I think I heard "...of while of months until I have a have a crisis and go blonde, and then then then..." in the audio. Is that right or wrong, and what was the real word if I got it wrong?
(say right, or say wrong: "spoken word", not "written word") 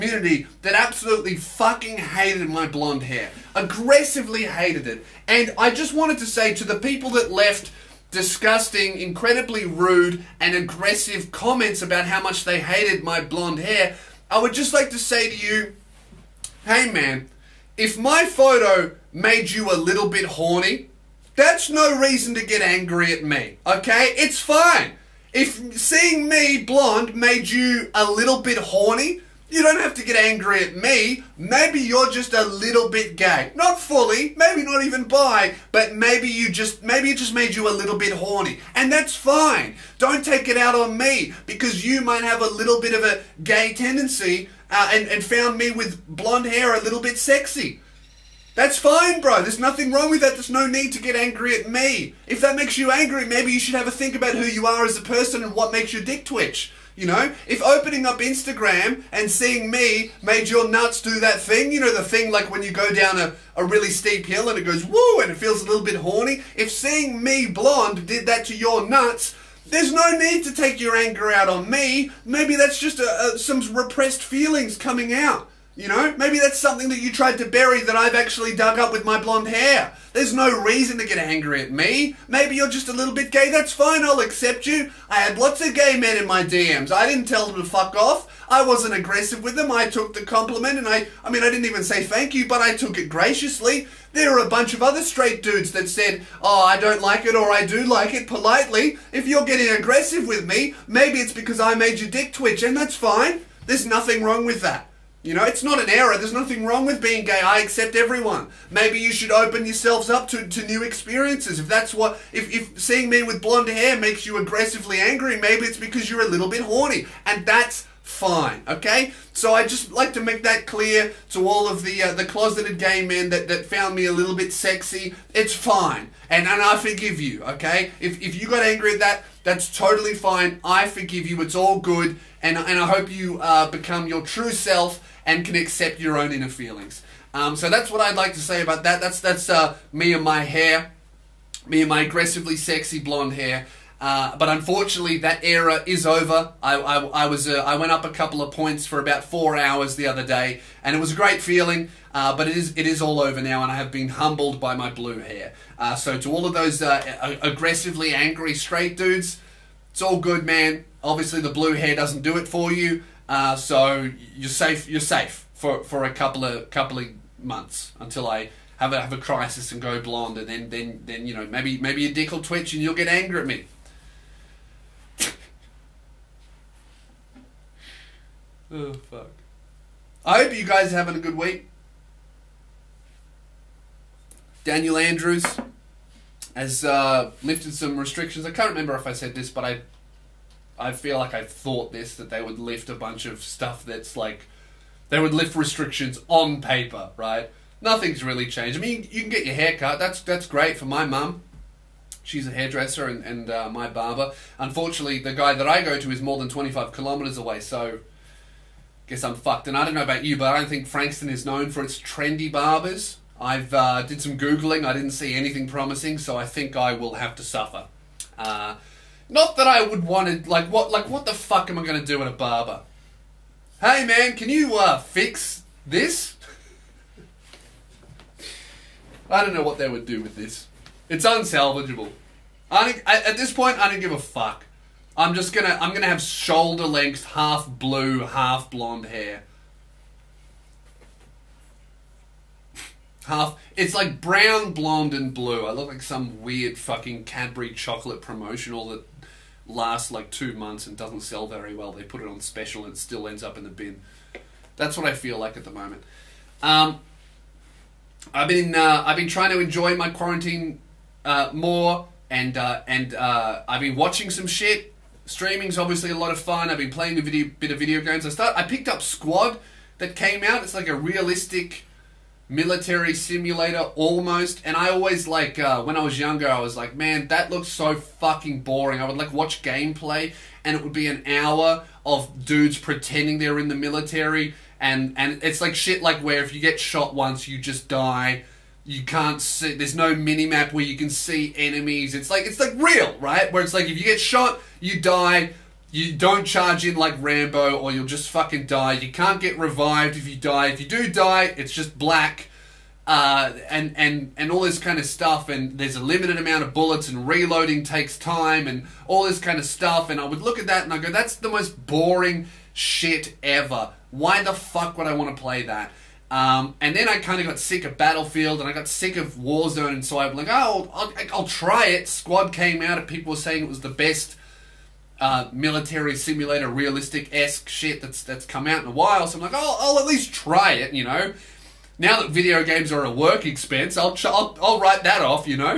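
wrong: "couple", not "while".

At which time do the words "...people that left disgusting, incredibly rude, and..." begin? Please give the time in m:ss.
0:06.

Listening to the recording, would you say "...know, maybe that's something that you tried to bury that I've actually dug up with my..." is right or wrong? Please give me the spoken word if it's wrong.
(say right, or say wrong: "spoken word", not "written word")
right.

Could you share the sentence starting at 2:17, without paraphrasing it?
Um, so that's what I'd like to say about that.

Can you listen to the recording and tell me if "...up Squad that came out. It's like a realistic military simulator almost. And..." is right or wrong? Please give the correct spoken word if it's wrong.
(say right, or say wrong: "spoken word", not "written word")
right.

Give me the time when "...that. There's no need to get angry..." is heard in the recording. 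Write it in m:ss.
0:50.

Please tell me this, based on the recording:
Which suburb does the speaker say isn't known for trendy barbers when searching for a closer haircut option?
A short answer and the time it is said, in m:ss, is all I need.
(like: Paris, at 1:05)
Frankston, at 3:30.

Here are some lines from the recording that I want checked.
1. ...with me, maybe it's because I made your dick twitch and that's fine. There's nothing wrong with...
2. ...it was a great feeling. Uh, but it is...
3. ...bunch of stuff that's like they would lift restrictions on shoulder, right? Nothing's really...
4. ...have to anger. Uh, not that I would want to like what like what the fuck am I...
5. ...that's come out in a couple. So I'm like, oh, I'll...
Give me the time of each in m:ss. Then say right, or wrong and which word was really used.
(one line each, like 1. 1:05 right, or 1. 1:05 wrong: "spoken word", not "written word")
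1. 1:40 right
2. 2:30 right
3. 3:12 wrong: "paper", not "shoulder"
4. 3:37 wrong: "suffer", not "anger"
5. 5:28 wrong: "while", not "couple".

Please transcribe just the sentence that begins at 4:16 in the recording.
Um, I've been uh, I've been trying to enjoy my quarantine uh, more, and uh, and uh, I've been watching some shit.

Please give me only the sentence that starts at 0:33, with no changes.
Not fully, maybe not even bi, but maybe you just maybe it just made you a little bit horny.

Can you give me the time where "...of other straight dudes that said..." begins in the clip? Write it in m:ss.
1:34.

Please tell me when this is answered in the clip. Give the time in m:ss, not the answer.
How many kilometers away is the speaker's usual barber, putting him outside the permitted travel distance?
3:26.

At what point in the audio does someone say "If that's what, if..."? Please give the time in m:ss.
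1:51.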